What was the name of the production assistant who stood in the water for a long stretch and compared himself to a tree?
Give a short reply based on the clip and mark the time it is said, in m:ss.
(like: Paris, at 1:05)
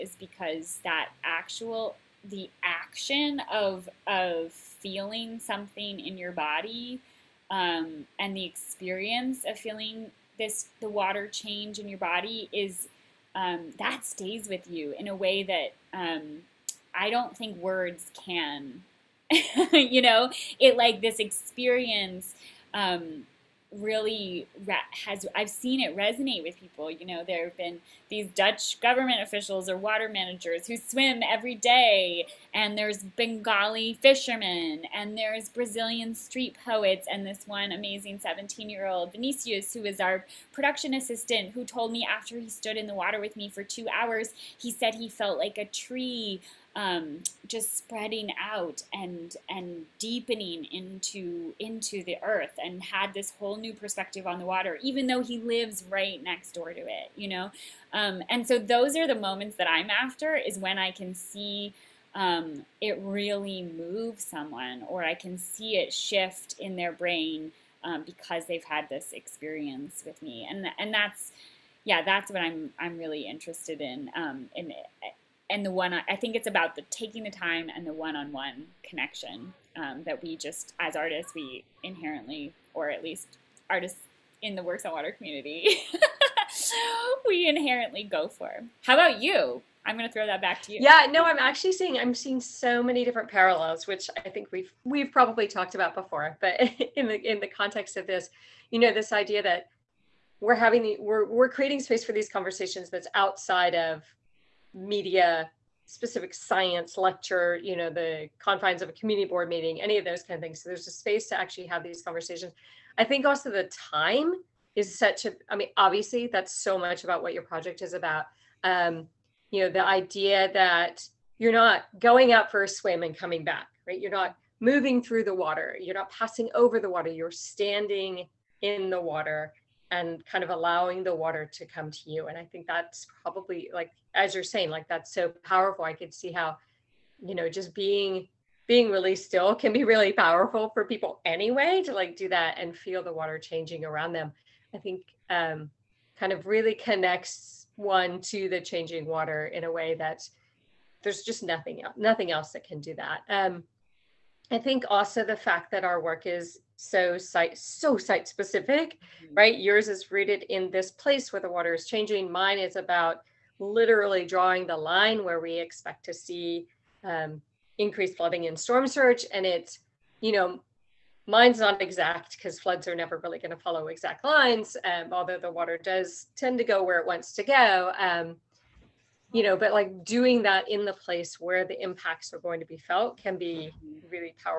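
Vinicius, at 0:39.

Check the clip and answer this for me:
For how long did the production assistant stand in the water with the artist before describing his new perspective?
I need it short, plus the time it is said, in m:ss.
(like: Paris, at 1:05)
2 hours, at 0:43.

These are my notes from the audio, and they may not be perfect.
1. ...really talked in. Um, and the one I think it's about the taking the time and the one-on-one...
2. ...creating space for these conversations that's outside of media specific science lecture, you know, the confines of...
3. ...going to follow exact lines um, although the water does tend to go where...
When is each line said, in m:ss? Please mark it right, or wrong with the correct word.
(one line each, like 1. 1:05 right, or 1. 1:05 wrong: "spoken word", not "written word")
1. 1:12 wrong: "interested", not "talked"
2. 1:41 right
3. 2:53 right.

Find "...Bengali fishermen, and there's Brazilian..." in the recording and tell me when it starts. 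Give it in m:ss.
0:33.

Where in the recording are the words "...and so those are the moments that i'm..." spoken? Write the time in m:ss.
0:58.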